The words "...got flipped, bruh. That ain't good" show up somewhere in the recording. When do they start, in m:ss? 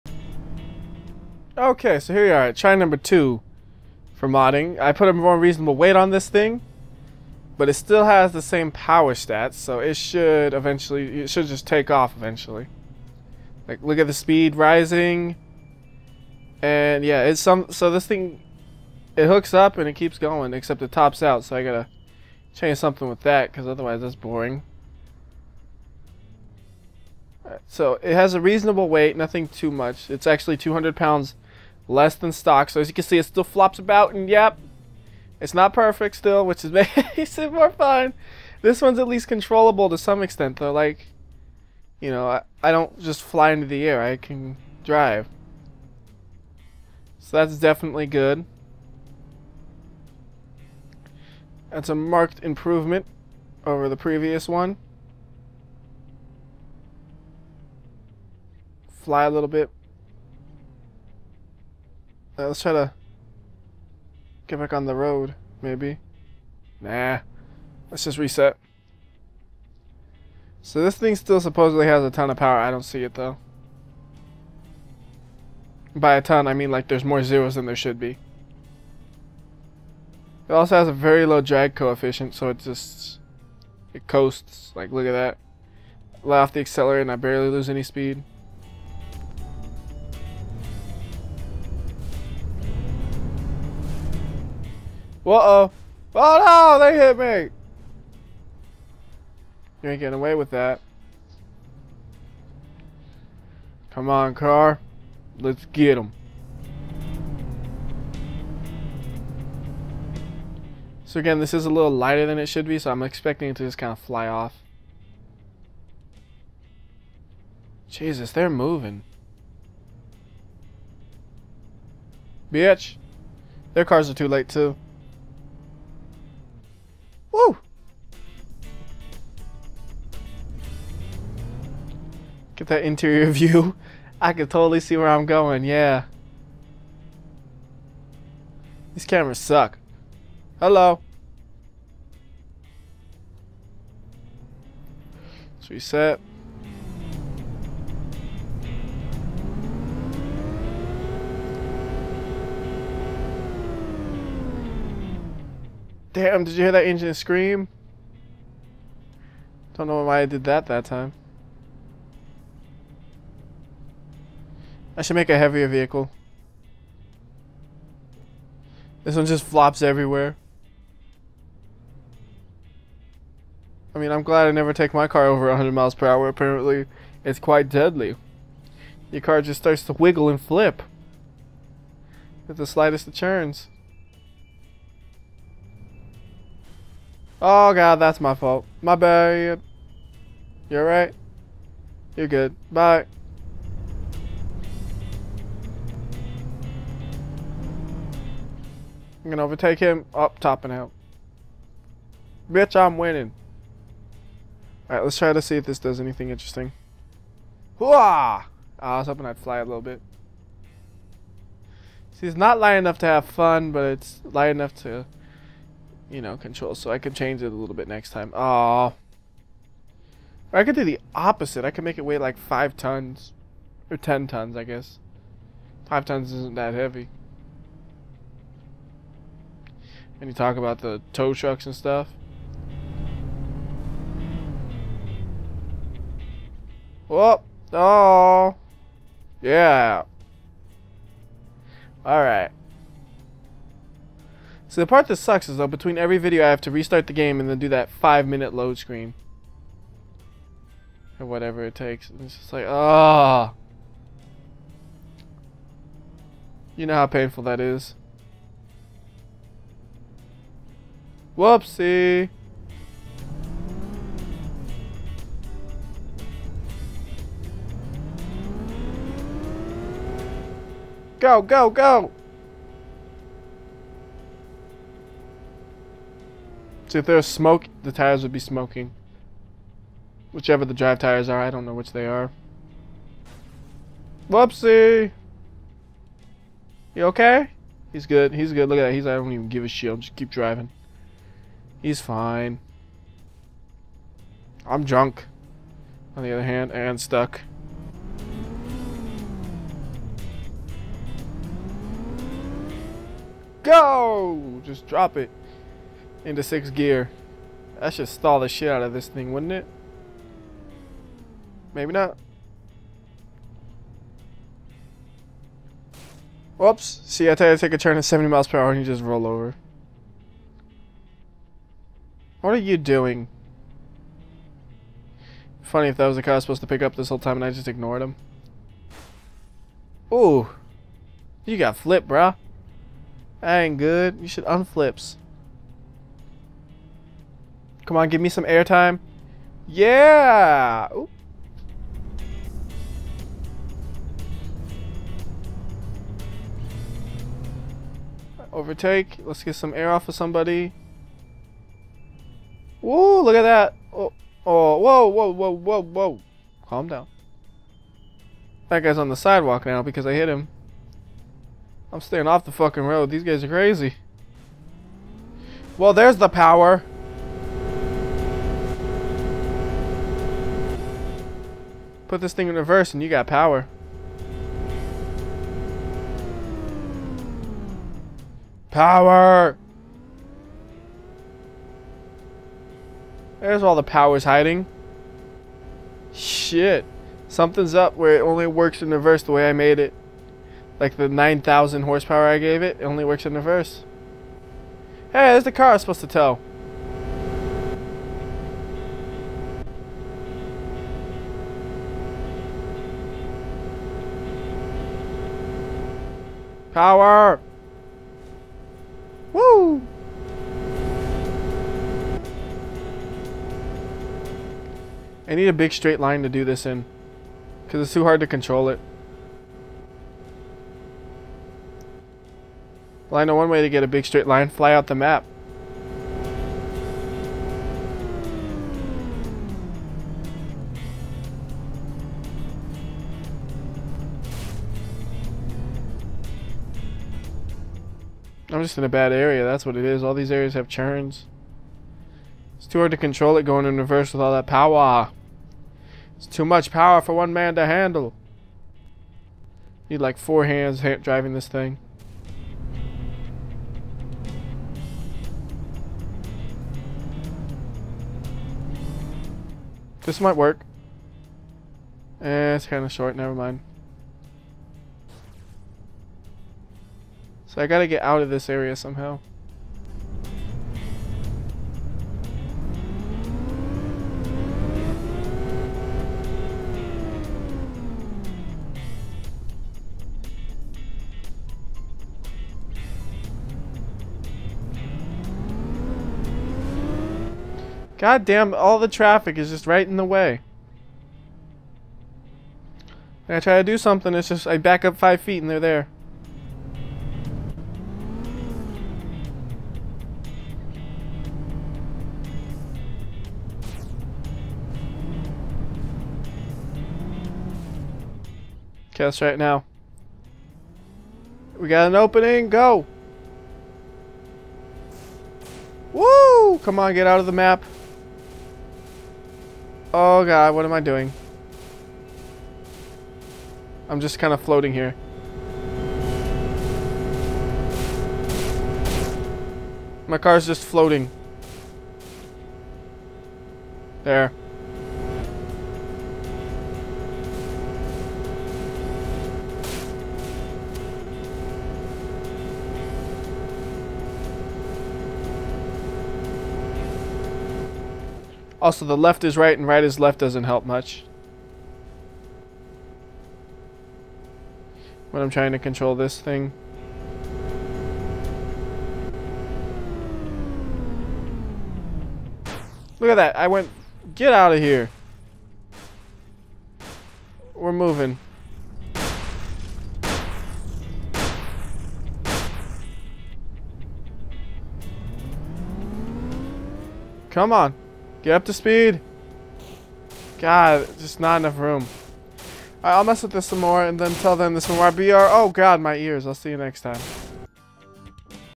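5:31.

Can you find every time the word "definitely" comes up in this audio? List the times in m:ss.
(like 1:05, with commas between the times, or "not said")
0:47.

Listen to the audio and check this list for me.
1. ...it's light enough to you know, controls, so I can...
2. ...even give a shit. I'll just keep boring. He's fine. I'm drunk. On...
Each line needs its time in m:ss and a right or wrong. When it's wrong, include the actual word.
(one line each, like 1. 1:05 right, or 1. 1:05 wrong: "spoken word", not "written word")
1. 3:33 right
2. 4:49 wrong: "driving", not "boring".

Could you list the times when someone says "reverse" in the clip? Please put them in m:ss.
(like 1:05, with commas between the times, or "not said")
6:12, 6:28, 6:33, 7:23.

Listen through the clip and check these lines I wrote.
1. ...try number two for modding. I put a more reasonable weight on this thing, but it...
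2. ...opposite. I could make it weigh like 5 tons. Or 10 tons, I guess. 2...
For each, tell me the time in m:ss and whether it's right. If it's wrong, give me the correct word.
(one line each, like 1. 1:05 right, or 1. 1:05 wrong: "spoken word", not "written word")
1. 0:02 right
2. 3:41 wrong: "5", not "2".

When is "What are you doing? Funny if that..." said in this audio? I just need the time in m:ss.
5:22.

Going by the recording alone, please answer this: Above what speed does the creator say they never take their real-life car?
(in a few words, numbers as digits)
100 miles per hour.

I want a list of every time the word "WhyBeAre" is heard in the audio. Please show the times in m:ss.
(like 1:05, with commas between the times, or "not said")
9:44.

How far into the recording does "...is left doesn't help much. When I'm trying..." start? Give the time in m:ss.
9:09.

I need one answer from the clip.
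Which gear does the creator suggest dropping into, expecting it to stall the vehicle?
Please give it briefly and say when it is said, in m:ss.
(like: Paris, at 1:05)
sixth gear, at 5:06.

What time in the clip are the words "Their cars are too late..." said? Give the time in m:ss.
2:03.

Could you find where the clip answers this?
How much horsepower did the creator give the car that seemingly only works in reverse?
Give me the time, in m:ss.
6:31.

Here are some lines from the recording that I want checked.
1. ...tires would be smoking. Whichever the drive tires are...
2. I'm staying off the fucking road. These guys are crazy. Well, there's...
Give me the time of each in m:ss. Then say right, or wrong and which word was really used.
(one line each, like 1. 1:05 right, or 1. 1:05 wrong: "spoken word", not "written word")
1. 4:37 right
2. 6:01 right.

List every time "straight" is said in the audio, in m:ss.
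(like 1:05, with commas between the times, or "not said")
6:55, 7:04.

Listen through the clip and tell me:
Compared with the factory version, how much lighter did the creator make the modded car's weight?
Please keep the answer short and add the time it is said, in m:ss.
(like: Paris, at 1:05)
200 pounds, at 0:30.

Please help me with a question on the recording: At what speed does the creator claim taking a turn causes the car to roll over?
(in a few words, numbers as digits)
70 miles per hour.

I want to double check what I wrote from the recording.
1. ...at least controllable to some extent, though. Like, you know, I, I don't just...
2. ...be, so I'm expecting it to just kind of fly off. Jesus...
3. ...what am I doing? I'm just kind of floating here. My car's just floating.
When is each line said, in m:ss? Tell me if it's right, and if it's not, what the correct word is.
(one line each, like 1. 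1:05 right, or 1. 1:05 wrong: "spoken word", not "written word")
1. 0:38 right
2. 1:52 right
3. 8:40 right.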